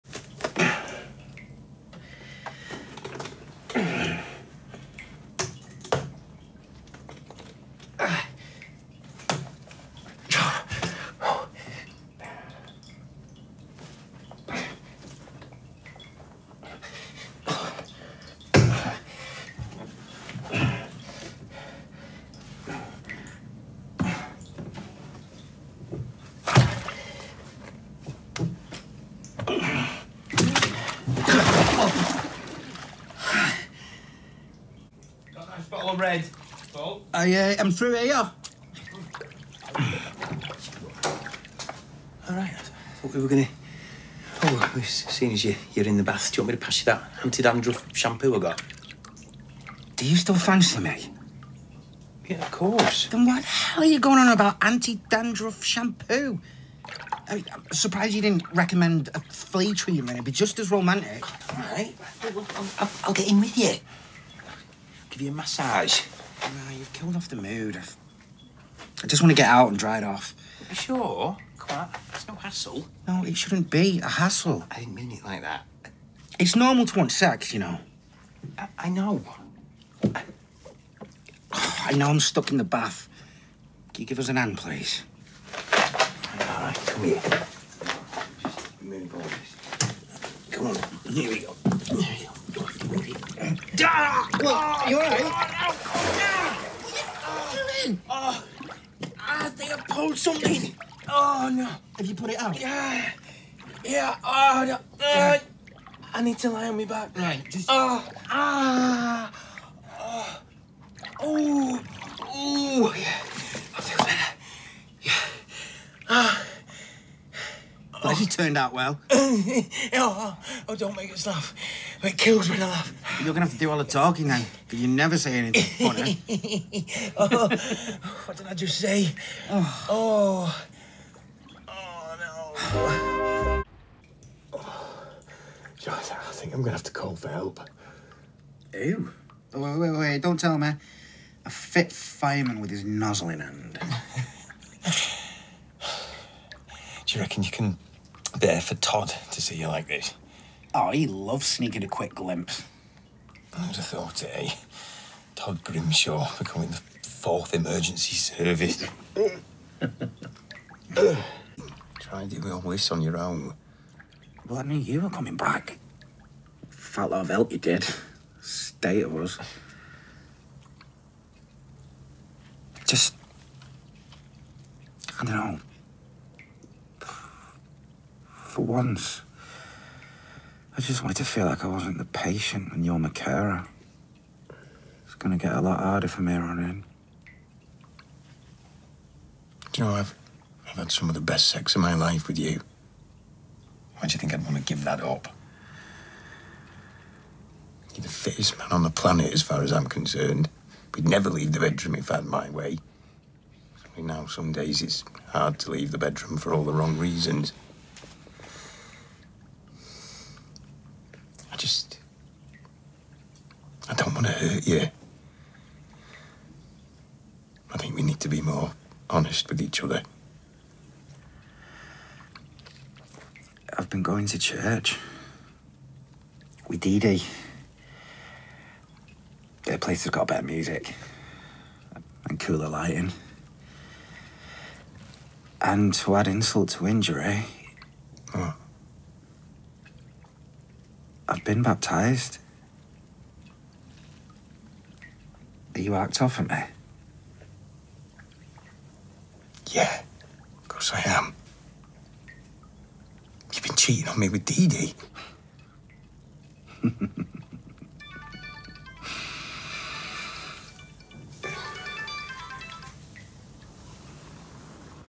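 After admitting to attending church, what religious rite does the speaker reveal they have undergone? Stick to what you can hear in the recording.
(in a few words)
baptised.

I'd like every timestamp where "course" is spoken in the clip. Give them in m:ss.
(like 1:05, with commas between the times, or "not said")
0:52, 4:10.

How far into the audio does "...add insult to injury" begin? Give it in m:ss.
3:56.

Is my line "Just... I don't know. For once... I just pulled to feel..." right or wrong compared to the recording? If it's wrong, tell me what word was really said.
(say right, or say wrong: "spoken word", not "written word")
wrong: "wanted", not "pulled".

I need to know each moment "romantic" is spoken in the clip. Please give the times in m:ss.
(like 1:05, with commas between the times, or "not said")
1:00.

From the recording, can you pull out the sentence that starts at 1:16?
It's normal to want sex, you know.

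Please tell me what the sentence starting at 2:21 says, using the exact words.
A fit fireman with his nozzle in hand.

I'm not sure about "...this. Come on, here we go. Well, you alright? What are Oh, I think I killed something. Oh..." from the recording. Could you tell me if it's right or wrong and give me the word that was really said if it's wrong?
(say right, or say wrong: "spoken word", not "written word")
wrong: "pulled", not "killed".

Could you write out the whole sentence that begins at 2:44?
Well, I knew you were coming back.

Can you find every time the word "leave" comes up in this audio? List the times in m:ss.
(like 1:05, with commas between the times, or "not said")
3:21, 3:25.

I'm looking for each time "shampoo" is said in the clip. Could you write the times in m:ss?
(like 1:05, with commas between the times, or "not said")
0:47, 0:55.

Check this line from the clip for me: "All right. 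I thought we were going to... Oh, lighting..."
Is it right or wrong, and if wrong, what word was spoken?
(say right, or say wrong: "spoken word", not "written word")
wrong: "seeing", not "lighting".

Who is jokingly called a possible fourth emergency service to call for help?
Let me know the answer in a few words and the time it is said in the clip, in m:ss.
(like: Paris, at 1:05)
Todd Grimshaw, at 2:35.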